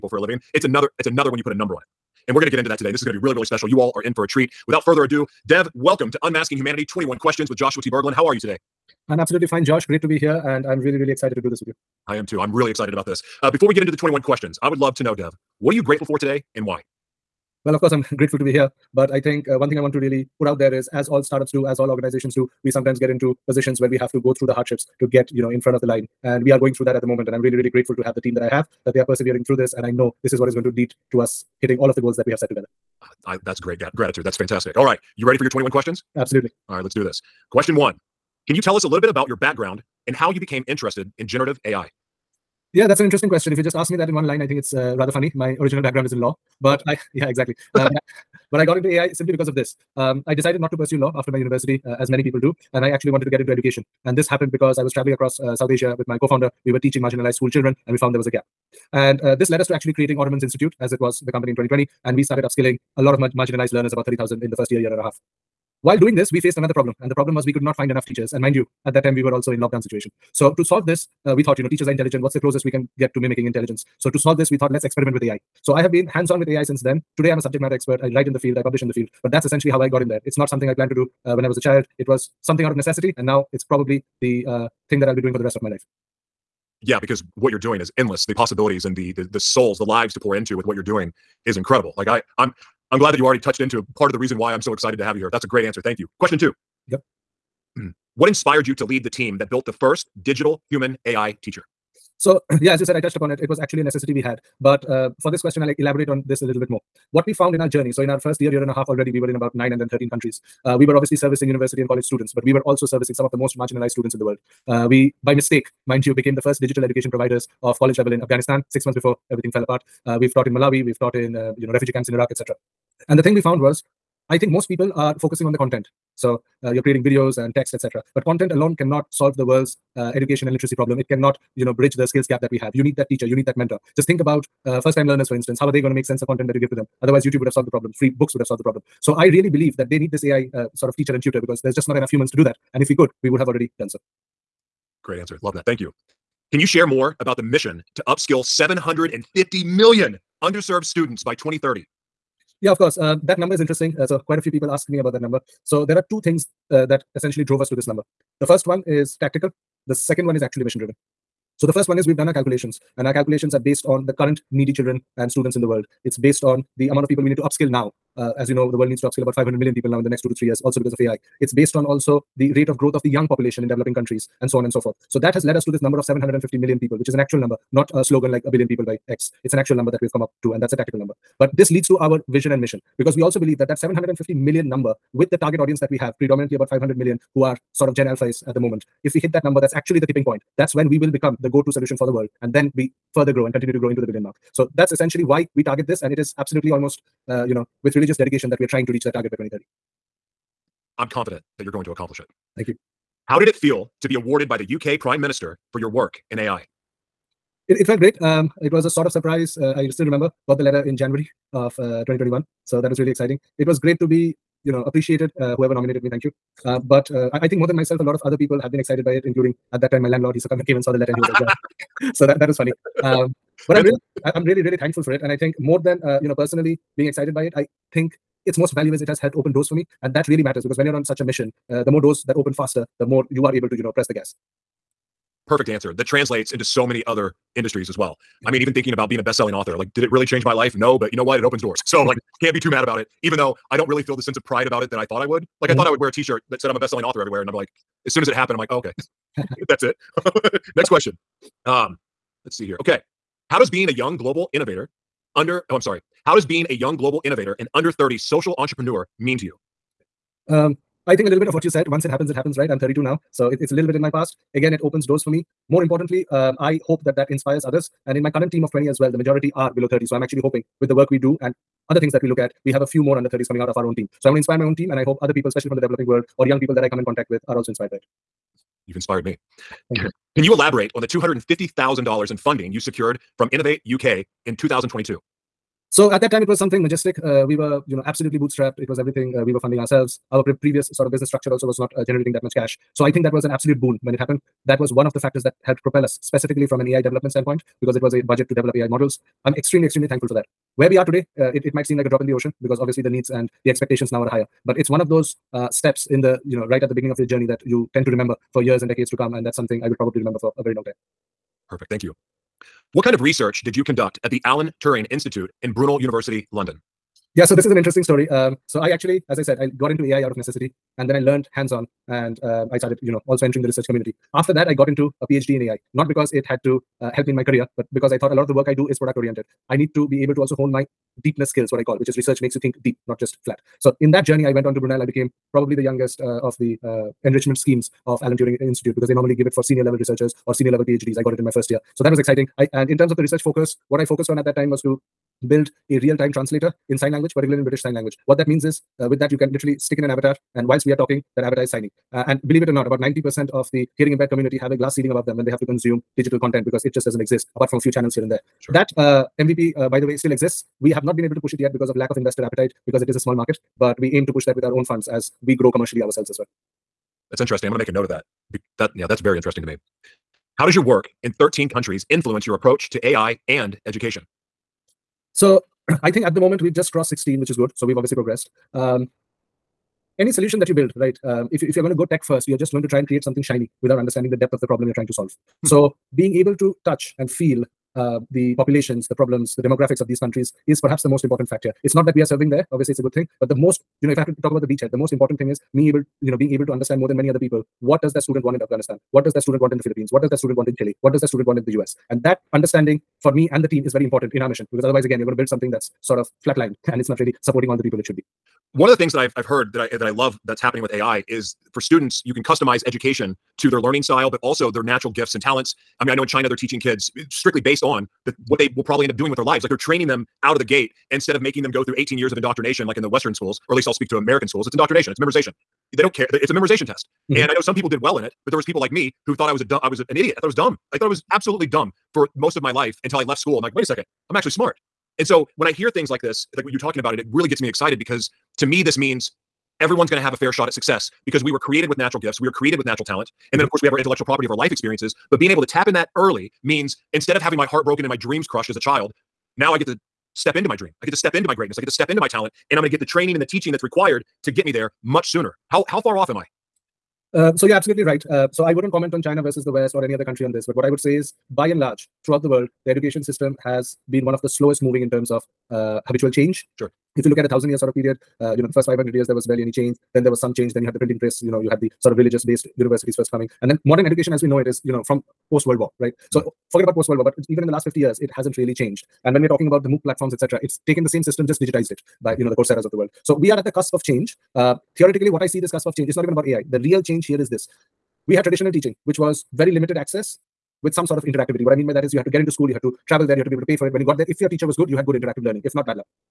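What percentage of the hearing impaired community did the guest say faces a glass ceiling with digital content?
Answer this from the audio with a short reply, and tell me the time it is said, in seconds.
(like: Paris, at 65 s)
90%, at 352 s.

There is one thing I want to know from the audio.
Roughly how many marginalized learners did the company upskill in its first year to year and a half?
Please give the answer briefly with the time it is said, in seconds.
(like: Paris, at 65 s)
30,000, at 63 s.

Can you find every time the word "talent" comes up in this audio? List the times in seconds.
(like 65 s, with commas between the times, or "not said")
415 s, 443 s, 452 s.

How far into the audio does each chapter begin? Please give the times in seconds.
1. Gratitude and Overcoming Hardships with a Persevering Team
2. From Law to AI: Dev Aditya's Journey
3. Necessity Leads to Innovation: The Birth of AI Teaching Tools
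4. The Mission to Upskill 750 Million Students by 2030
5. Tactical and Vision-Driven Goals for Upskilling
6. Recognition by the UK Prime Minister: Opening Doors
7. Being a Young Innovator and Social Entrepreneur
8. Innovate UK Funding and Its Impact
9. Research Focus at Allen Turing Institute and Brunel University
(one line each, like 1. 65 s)
1. 7 s
2. 37 s
3. 76 s
4. 105 s
5. 147 s
6. 203 s
7. 241 s
8. 282 s
9. 315 s.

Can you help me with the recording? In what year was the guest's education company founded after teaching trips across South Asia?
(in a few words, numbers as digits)
2020.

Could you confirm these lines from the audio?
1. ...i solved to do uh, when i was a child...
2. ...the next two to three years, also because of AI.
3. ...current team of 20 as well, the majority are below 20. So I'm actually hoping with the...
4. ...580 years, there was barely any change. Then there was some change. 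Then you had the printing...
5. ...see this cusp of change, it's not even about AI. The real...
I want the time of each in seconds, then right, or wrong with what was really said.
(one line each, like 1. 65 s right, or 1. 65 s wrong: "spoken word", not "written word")
1. 80 s wrong: "planned", not "solved"
2. 170 s right
3. 268 s wrong: "30", not "20"
4. 468 s wrong: "500", not "580"
5. 485 s right.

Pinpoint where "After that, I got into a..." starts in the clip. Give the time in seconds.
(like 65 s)
324 s.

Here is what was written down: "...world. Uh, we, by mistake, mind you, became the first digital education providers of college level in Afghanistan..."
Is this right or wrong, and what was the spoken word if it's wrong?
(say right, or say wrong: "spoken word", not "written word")
right.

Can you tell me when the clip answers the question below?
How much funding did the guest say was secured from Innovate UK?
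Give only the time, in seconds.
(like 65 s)
281 s.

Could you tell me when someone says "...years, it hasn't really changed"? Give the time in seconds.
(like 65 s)
477 s.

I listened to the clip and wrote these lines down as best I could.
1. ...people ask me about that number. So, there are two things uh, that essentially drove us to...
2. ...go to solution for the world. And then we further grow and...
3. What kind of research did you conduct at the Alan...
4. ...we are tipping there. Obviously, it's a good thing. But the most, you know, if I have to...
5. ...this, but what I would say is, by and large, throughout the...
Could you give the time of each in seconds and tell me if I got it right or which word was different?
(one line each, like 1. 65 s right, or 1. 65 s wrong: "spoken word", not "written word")
1. 154 s right
2. 191 s right
3. 312 s right
4. 392 s wrong: "serving", not "tipping"
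5. 460 s right.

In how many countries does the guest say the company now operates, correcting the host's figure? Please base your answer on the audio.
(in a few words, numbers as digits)
16.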